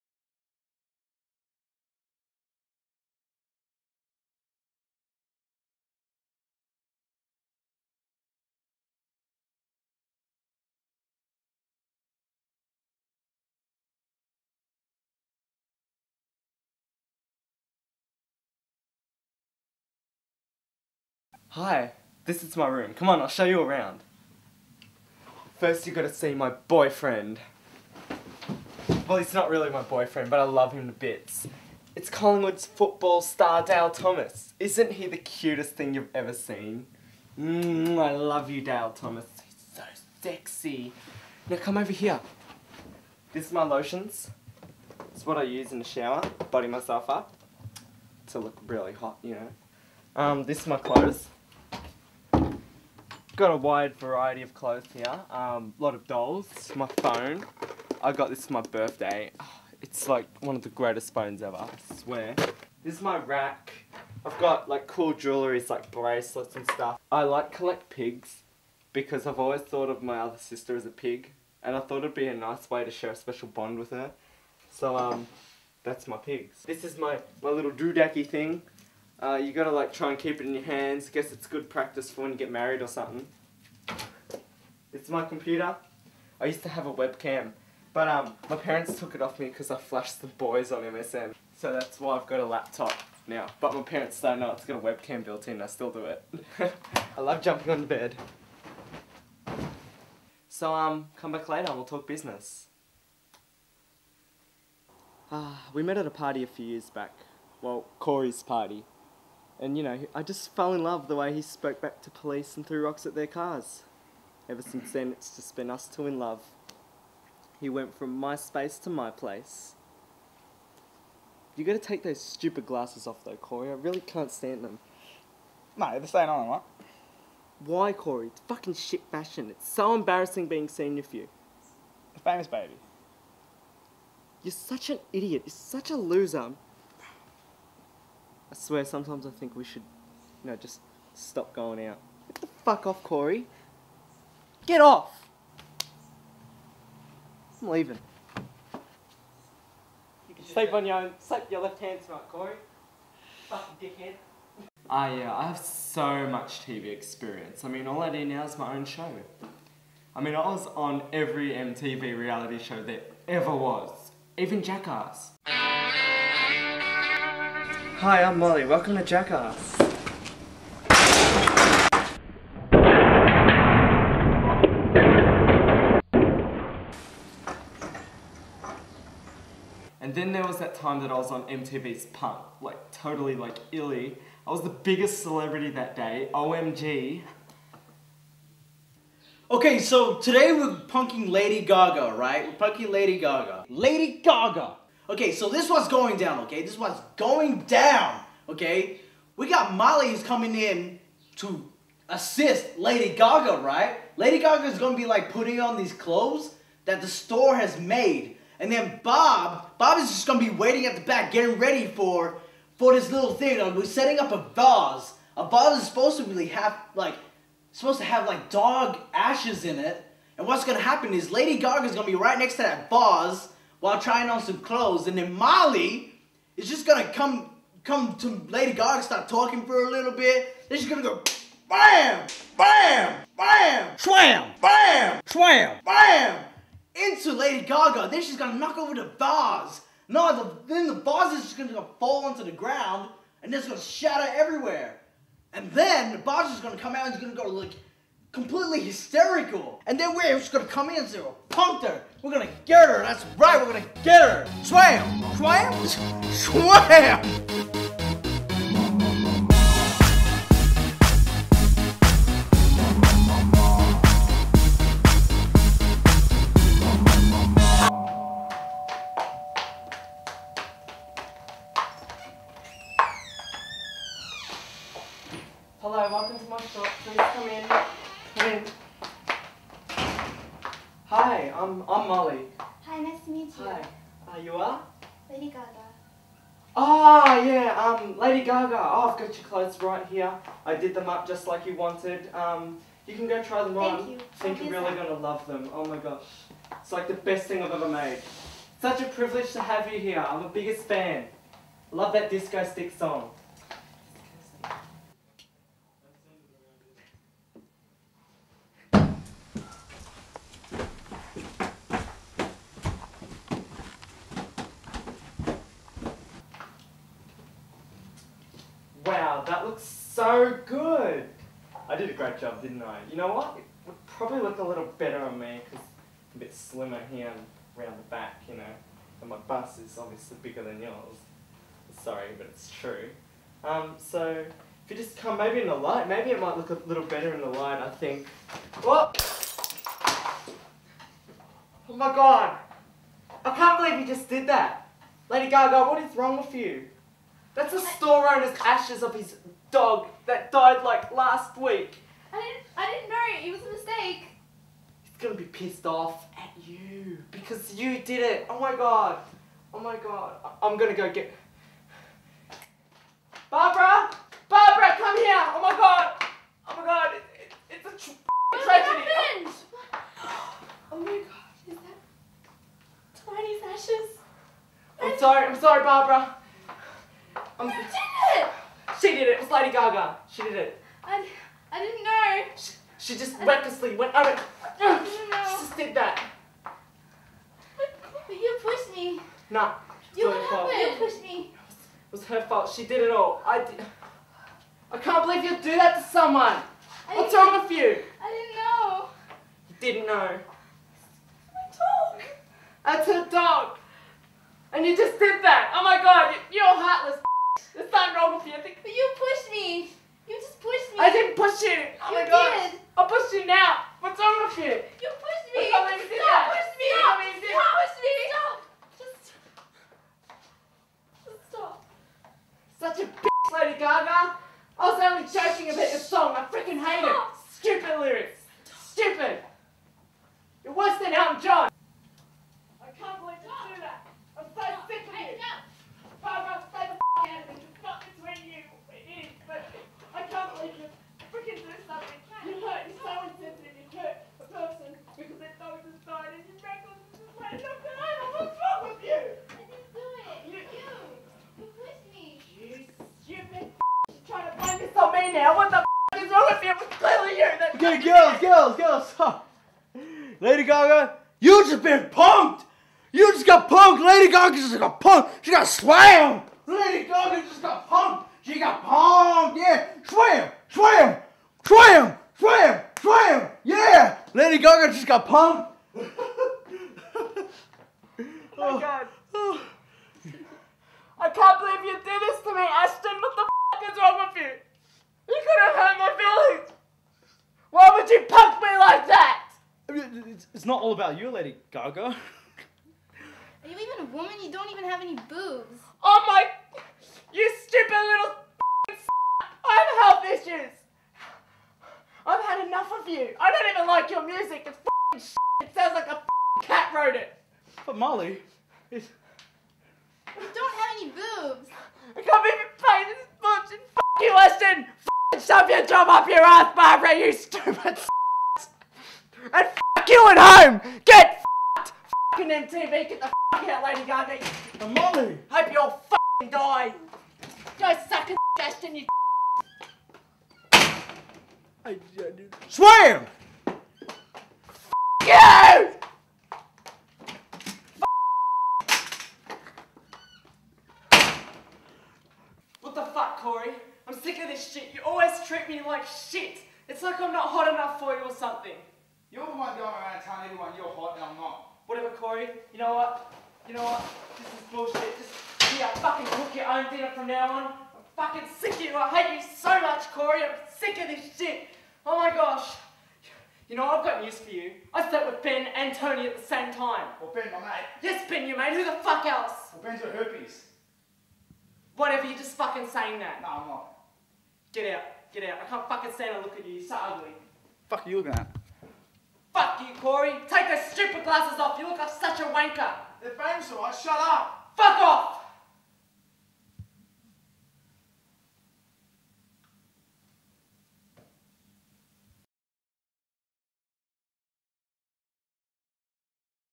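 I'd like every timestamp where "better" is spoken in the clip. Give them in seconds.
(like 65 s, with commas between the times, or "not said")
324 s, 337 s.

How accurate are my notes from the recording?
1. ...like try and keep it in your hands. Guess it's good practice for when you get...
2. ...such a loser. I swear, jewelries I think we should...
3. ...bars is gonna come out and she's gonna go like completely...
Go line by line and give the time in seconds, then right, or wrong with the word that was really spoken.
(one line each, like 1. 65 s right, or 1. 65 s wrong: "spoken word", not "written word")
1. 79 s right
2. 135 s wrong: "sometimes", not "jewelries"
3. 246 s right.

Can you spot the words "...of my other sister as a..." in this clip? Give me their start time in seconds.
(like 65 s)
69 s.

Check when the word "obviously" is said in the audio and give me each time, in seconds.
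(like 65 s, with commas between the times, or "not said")
329 s.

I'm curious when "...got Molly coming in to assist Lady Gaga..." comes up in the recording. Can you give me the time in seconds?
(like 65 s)
199 s.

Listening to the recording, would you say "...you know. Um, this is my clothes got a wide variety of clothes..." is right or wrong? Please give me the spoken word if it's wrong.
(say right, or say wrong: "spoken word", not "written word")
right.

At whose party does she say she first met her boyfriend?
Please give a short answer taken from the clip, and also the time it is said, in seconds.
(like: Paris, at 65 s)
Corey's party, at 107 s.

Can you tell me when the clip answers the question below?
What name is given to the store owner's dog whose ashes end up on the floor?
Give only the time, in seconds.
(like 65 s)
373 s.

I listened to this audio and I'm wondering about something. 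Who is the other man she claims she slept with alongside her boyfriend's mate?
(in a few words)
Tony.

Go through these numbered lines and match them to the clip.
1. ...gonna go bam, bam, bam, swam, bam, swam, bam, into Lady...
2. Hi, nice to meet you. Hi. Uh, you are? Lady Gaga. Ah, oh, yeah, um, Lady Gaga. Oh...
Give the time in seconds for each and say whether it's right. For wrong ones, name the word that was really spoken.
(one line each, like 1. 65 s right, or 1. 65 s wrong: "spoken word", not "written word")
1. 230 s right
2. 282 s right.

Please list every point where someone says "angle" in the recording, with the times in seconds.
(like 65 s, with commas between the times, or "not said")
not said.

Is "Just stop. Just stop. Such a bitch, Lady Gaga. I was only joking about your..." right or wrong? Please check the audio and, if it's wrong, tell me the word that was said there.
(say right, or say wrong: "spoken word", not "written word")
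right.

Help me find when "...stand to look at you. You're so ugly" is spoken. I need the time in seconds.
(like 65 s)
576 s.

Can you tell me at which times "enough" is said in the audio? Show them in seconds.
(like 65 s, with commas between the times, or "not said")
502 s, 547 s.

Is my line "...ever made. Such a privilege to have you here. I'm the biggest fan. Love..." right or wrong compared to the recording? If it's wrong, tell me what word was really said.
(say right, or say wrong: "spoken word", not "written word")
right.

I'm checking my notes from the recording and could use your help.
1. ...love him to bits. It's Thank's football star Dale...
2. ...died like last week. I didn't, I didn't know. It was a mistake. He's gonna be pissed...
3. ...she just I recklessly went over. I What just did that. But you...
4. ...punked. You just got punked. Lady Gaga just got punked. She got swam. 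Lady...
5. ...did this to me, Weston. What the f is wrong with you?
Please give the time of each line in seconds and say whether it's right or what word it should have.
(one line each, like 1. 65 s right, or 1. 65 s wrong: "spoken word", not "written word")
1. 30 s wrong: "Collingwood", not "Thank"
2. 350 s right
3. 382 s wrong: "She", not "What"
4. 462 s right
5. 482 s wrong: "Ashton", not "Weston".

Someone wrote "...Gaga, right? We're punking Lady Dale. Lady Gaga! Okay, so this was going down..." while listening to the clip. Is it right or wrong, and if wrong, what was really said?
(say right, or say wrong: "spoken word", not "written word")
wrong: "Gaga", not "Dale".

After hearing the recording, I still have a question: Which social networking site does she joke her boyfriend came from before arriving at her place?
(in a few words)
MySpace.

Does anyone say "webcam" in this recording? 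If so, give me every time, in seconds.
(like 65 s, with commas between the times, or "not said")
86 s, 94 s.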